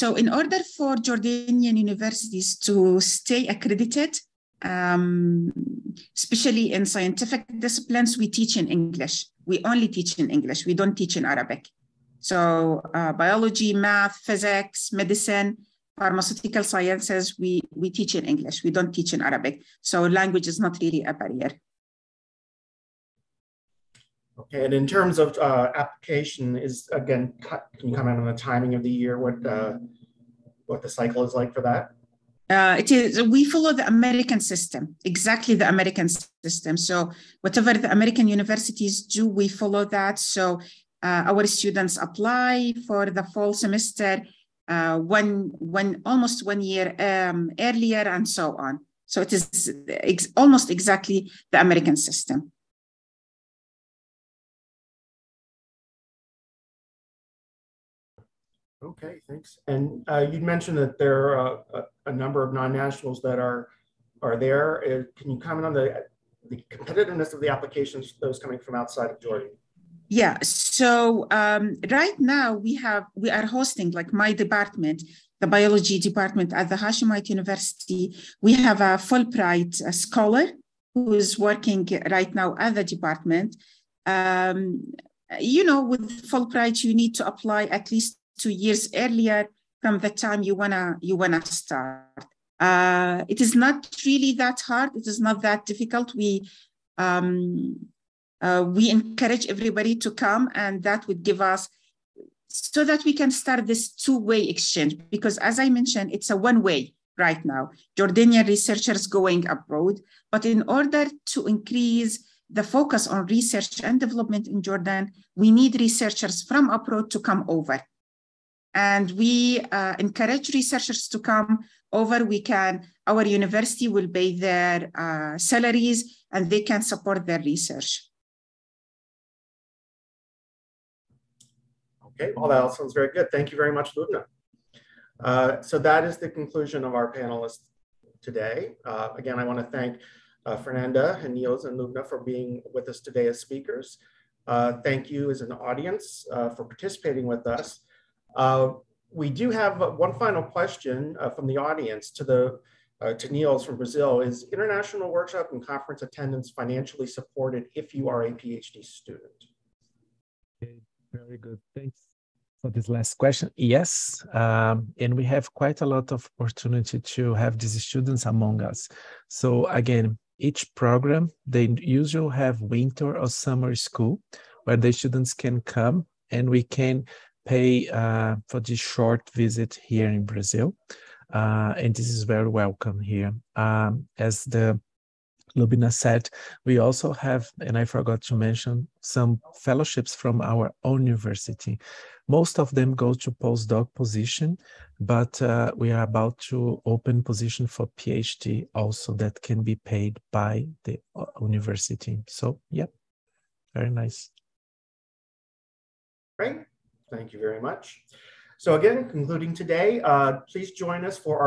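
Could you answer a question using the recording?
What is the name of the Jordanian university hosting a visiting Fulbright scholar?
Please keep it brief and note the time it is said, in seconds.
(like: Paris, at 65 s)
Hashemite University, at 76 s.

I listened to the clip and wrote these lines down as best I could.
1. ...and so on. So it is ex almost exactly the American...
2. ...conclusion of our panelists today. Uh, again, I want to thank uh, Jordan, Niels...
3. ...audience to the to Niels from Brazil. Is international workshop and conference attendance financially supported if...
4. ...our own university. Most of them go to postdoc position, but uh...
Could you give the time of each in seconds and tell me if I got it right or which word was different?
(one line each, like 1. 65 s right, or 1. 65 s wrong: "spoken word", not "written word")
1. 48 s right
2. 136 s wrong: "Fernanda", not "Jordan"
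3. 151 s right
4. 190 s right.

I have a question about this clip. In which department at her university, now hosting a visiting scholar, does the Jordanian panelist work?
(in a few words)
Biology department.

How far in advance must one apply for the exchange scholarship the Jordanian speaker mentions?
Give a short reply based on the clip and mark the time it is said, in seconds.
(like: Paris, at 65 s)
Two years, at 88 s.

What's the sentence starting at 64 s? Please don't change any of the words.
Uh, can you comment on the the competitiveness of the applications those coming from outside of Jordan?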